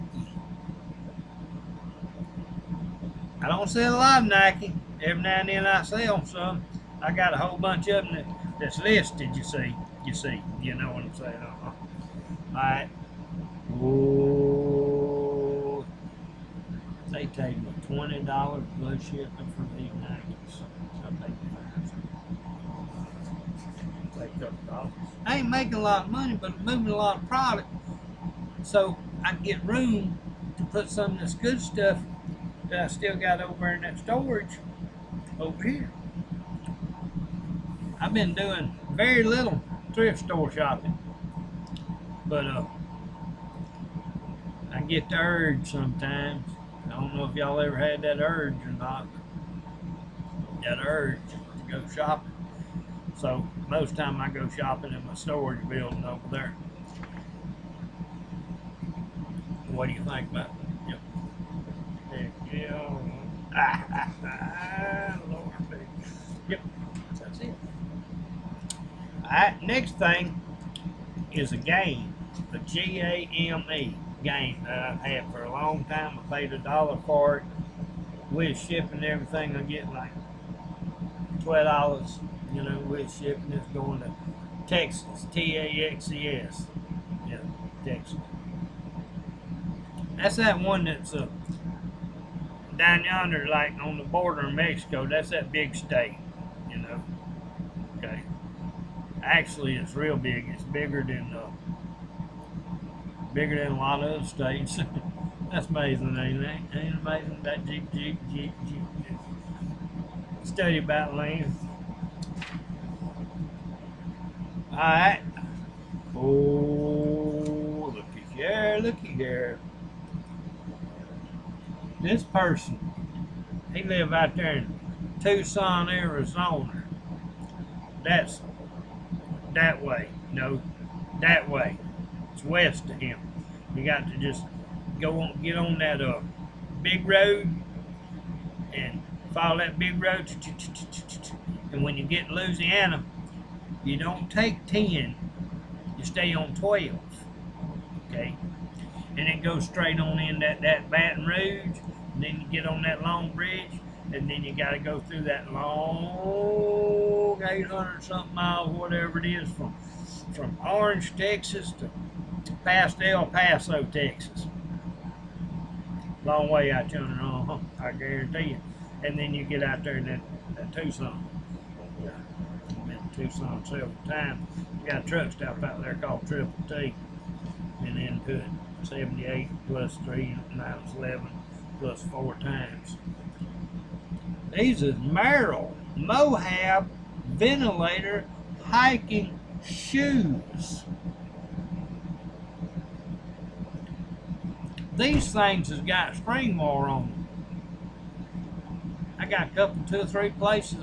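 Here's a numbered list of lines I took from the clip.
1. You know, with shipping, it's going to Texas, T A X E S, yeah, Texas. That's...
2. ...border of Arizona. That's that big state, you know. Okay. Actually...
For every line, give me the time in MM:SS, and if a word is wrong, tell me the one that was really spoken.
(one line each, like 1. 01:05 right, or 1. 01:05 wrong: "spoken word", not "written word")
1. 01:22 right
2. 01:34 wrong: "Mexico", not "Arizona".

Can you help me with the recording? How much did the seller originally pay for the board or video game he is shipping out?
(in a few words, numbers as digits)
a dollar.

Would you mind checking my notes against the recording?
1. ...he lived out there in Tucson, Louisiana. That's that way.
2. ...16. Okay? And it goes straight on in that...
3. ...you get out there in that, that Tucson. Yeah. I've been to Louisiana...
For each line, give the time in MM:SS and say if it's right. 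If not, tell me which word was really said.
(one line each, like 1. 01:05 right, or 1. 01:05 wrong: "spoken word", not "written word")
1. 02:03 wrong: "Arizona", not "Louisiana"
2. 02:26 wrong: "12", not "16"
3. 02:49 wrong: "Tucson", not "Louisiana".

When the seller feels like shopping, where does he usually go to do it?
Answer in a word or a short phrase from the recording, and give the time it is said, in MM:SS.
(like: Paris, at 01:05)
storage building, at 00:55.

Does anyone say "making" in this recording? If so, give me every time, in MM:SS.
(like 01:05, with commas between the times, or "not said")
00:25.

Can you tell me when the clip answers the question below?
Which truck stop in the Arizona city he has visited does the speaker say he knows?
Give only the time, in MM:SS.
02:56.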